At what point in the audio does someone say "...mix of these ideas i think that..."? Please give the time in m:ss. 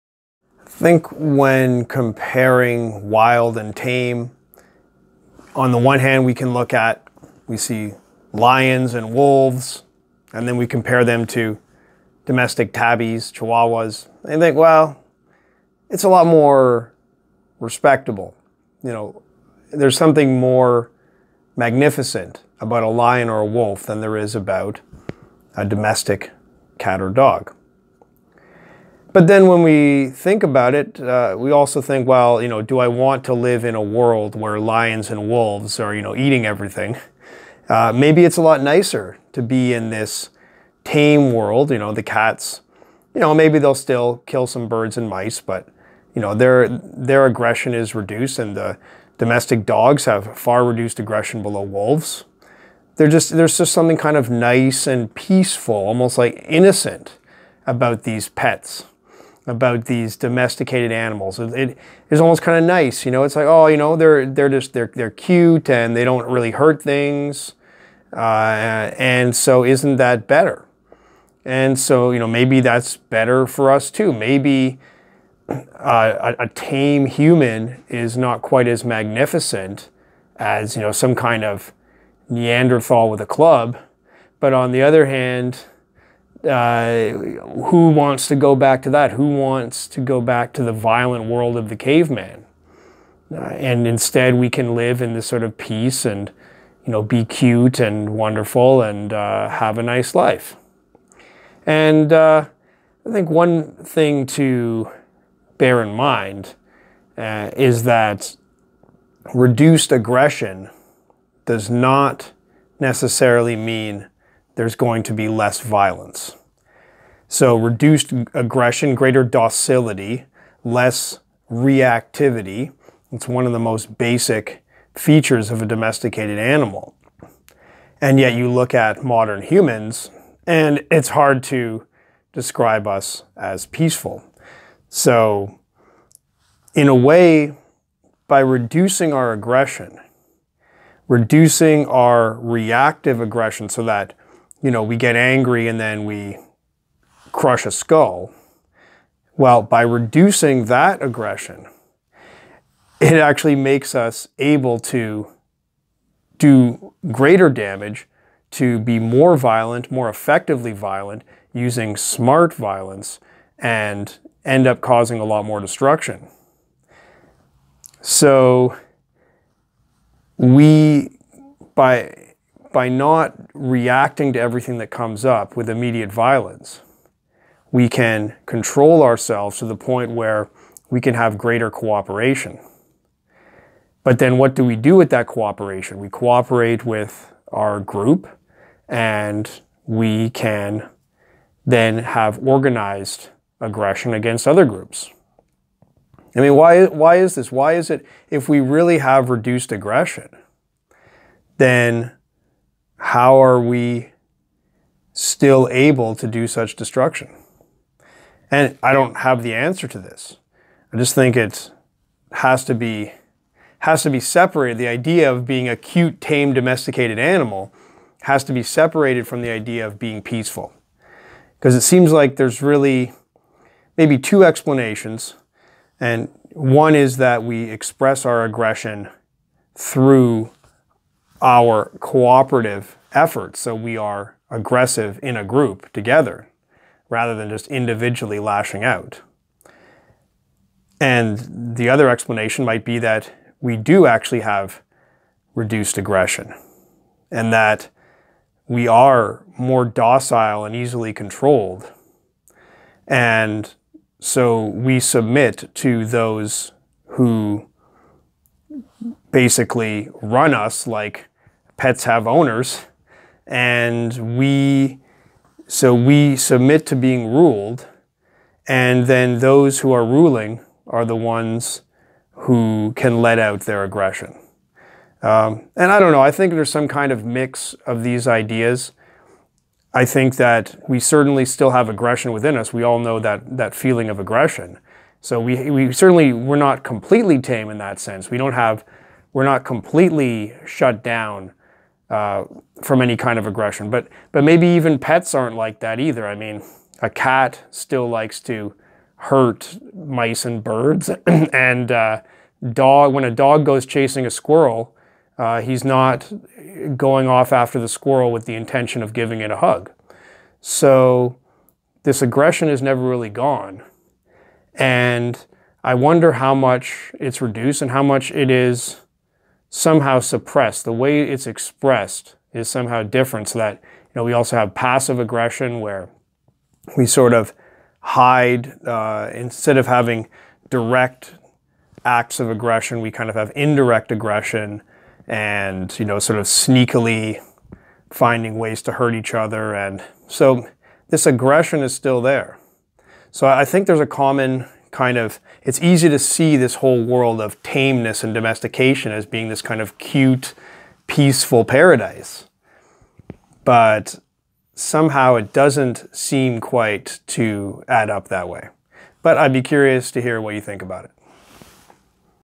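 4:37.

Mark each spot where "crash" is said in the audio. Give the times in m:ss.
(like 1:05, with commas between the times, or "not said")
not said.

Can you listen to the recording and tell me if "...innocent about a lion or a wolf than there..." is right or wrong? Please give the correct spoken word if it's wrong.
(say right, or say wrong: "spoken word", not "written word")
wrong: "magnificent", not "innocent".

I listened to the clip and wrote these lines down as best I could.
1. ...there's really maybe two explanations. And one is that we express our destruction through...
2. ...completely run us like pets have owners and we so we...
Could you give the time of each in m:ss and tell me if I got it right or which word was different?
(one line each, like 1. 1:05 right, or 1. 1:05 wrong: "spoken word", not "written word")
1. 3:42 wrong: "aggression", not "destruction"
2. 4:19 wrong: "basically", not "completely".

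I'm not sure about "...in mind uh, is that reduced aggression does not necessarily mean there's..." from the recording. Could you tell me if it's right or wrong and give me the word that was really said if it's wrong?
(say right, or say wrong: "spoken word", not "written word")
right.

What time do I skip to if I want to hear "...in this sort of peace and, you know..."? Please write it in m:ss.
1:35.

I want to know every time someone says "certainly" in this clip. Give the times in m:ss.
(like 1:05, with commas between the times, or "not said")
4:40, 4:45.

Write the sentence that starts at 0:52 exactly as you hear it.
They're just, there's just something kind of nice and peaceful, almost like innocent about these pets about these domesticated animals.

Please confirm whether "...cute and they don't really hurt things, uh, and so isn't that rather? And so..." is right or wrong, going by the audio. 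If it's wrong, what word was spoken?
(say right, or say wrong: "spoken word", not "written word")
wrong: "better", not "rather".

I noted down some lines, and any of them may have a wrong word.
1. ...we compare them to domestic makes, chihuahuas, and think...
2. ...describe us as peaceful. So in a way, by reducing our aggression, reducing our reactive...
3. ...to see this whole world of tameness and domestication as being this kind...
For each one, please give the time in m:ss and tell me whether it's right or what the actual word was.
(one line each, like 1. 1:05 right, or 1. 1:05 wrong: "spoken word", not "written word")
1. 0:10 wrong: "tabbies", not "makes"
2. 2:12 right
3. 5:46 right.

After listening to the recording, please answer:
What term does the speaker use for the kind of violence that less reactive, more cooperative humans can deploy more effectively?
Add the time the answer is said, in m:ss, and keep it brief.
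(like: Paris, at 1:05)
smart violence, at 2:41.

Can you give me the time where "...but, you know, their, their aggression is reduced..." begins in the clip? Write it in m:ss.
0:45.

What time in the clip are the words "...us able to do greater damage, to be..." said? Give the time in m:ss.
2:33.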